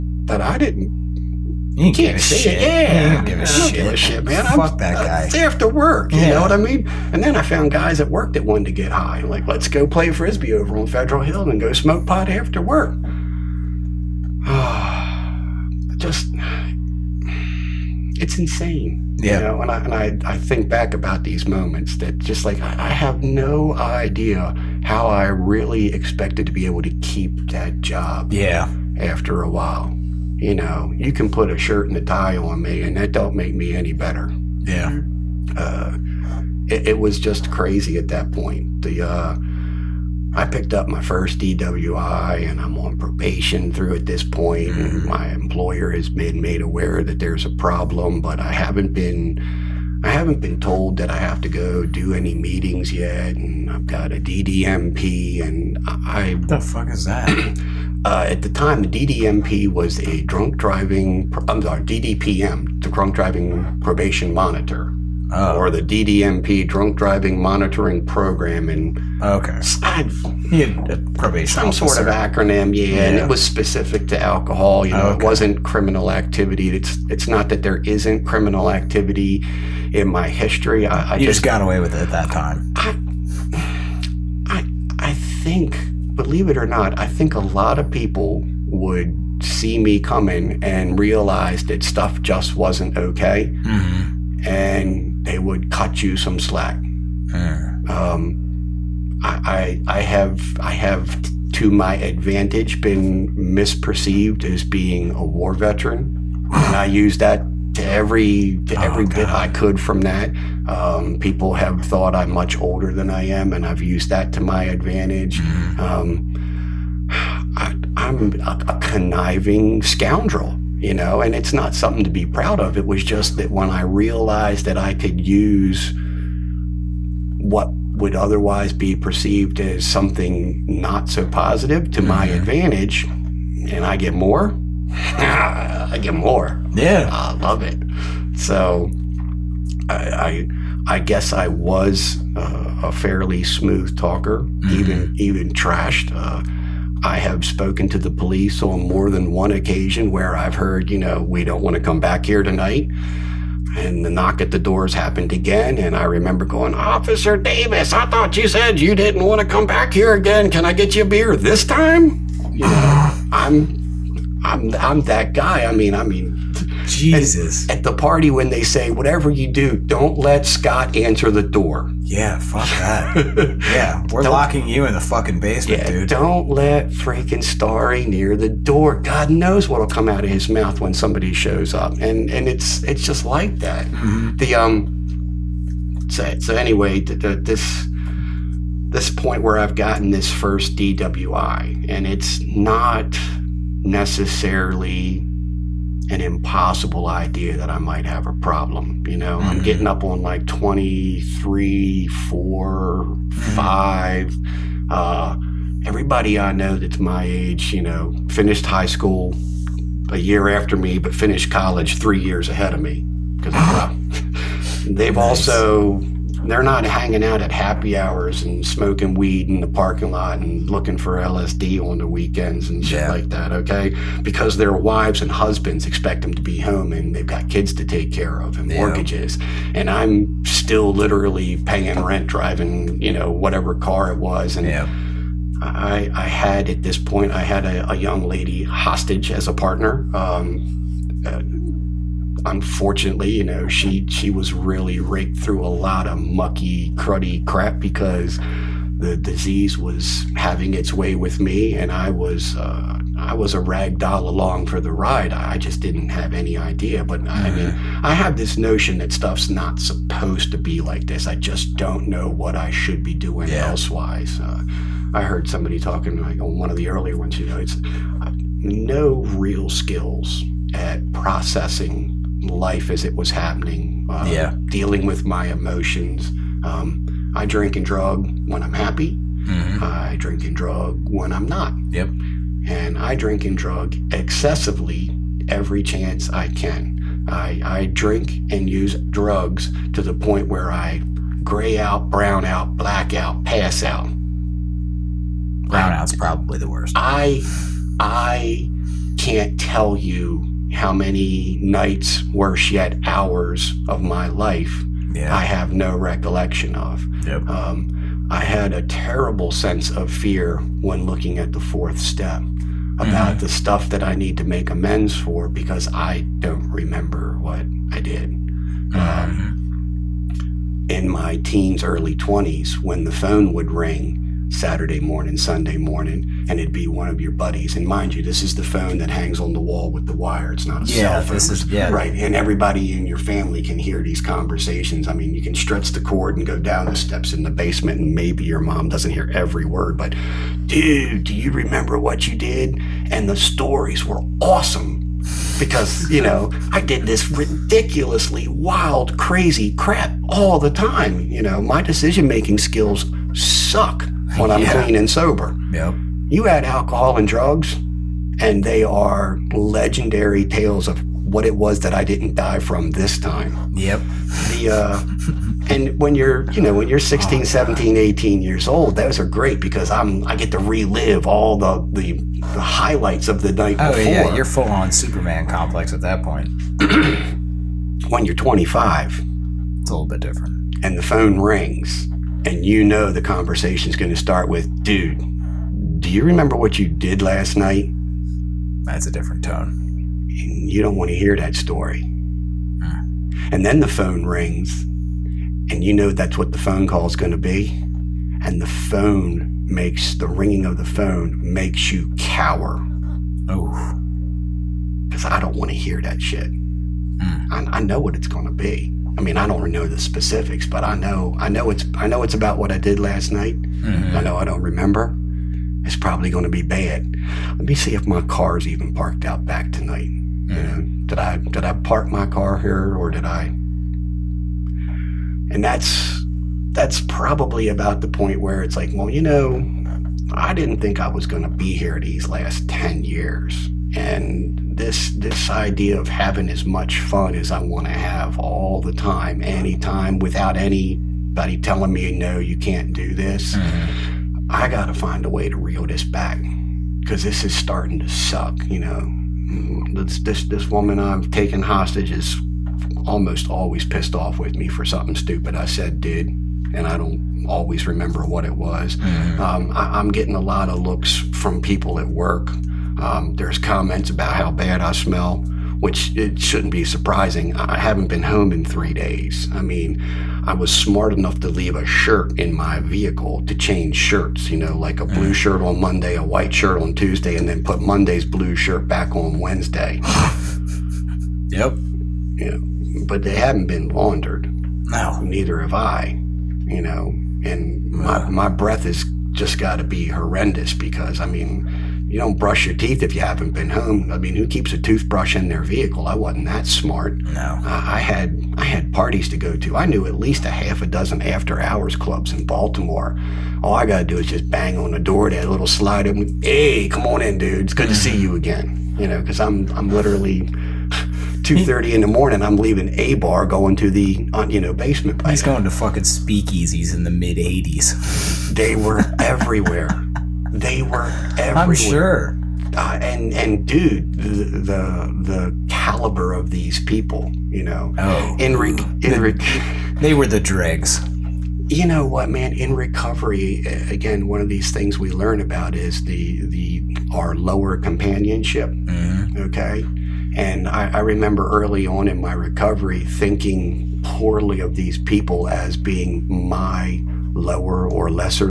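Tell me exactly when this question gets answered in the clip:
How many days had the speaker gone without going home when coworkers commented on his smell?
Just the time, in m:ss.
7:48.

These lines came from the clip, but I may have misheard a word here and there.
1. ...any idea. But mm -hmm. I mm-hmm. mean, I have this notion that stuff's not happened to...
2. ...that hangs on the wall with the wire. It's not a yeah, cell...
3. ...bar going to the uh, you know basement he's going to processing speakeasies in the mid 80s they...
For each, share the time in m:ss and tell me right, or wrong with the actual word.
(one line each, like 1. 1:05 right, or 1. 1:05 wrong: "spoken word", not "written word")
1. 4:16 wrong: "supposed", not "happened"
2. 5:28 right
3. 8:33 wrong: "fucking", not "processing".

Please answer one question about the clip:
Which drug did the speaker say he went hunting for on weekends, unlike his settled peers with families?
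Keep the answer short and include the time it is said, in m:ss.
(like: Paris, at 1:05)
LSD, at 3:41.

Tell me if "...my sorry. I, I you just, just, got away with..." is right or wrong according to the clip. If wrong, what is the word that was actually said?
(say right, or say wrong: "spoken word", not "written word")
wrong: "history", not "sorry".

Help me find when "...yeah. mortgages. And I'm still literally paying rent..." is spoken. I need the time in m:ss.
3:48.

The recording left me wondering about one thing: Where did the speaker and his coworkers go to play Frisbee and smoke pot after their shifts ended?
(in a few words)
Federal Hill.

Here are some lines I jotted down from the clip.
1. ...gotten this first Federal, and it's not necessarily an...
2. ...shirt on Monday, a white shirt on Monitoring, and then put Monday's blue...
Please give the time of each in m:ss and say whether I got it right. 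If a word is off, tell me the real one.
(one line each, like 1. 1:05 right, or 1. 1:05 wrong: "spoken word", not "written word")
1. 3:09 wrong: "DWI", not "Federal"
2. 7:55 wrong: "Tuesday", not "Monitoring".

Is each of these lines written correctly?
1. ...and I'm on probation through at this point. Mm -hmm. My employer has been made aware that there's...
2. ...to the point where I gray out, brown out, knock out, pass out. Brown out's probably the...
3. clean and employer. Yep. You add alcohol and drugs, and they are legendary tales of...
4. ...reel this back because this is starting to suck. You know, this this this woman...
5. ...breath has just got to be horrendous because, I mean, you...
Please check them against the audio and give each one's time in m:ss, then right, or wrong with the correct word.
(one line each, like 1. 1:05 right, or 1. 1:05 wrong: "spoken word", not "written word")
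1. 0:42 right
2. 4:49 wrong: "black", not "knock"
3. 5:54 wrong: "sober", not "employer"
4. 7:25 right
5. 8:08 right.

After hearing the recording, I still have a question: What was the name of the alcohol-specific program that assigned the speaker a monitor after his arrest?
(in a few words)
Drunk Driving Monitoring Program.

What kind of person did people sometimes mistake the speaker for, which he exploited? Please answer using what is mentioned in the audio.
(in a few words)
A war veteran.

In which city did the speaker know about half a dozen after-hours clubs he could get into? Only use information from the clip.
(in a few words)
Baltimore.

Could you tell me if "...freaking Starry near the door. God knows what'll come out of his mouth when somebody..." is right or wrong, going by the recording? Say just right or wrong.
right.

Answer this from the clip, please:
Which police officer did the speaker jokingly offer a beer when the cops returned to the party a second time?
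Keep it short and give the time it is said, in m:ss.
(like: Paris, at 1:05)
Officer Davis, at 2:36.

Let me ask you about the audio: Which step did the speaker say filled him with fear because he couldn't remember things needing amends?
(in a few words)
The fourth step.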